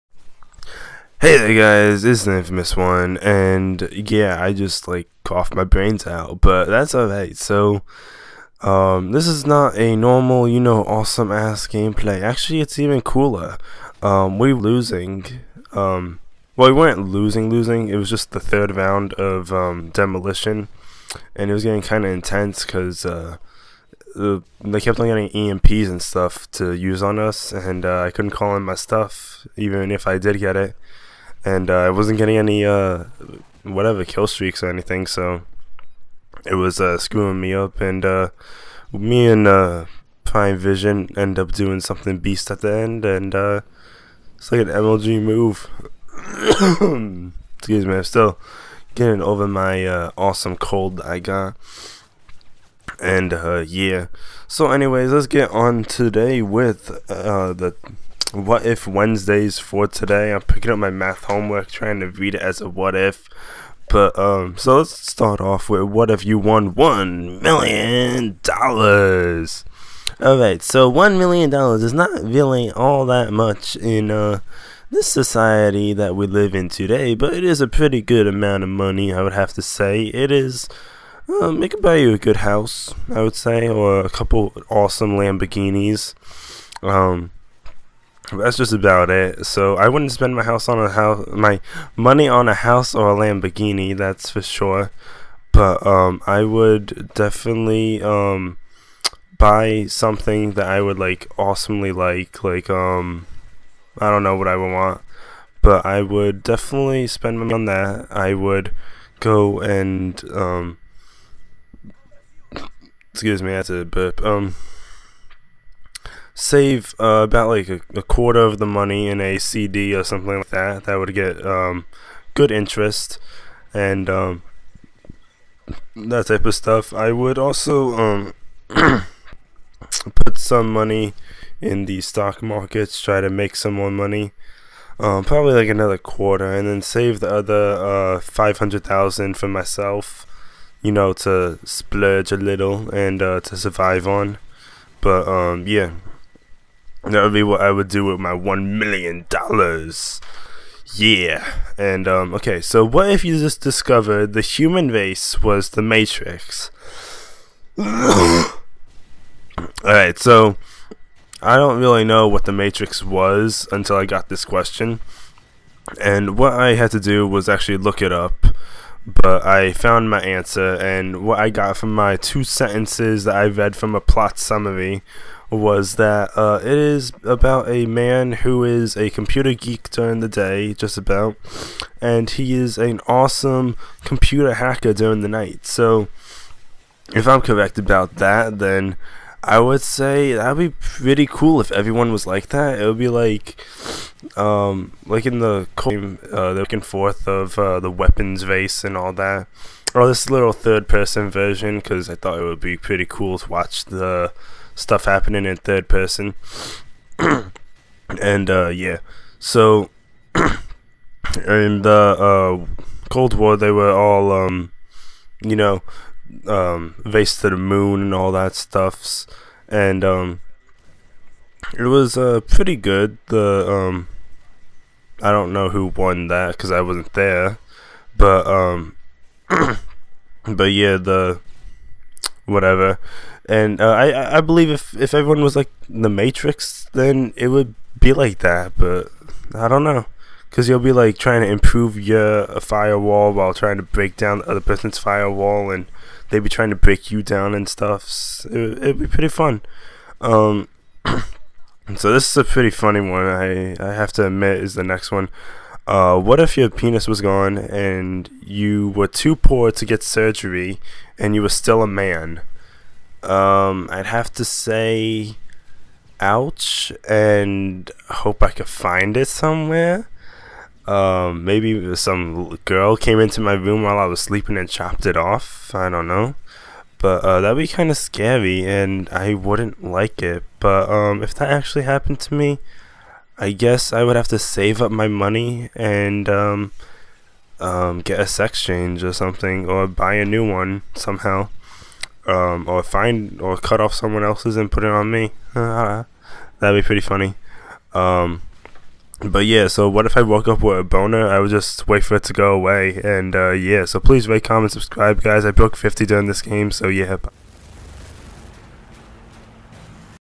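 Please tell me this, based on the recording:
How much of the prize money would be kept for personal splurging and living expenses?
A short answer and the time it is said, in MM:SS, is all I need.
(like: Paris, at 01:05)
$500,000, at 02:18.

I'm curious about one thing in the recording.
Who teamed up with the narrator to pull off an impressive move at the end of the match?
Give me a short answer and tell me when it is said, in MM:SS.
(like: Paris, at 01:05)
Prime Vision, at 00:40.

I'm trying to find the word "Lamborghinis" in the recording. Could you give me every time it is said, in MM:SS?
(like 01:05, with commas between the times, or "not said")
01:25, 01:33.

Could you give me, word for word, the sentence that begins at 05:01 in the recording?
I would just wait for it to go away.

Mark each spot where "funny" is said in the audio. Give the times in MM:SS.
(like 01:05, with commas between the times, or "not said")
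04:12, 04:57.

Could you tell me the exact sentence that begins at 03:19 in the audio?
Or oh, this little third-person version because I thought it would be pretty cool to watch the stuff happening in third person.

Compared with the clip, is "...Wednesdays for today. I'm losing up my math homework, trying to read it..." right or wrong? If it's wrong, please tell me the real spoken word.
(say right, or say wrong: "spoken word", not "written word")
wrong: "picking", not "losing".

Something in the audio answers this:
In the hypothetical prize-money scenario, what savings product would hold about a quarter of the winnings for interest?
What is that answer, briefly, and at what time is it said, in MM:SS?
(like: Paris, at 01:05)
CD, at 01:59.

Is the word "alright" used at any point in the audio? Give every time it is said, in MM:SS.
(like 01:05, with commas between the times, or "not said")
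00:06, 02:37.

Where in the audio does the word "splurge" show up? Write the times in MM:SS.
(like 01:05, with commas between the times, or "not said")
02:21.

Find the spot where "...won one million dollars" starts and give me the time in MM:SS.
01:06.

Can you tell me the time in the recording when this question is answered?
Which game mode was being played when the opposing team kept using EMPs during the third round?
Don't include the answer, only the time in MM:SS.
00:19.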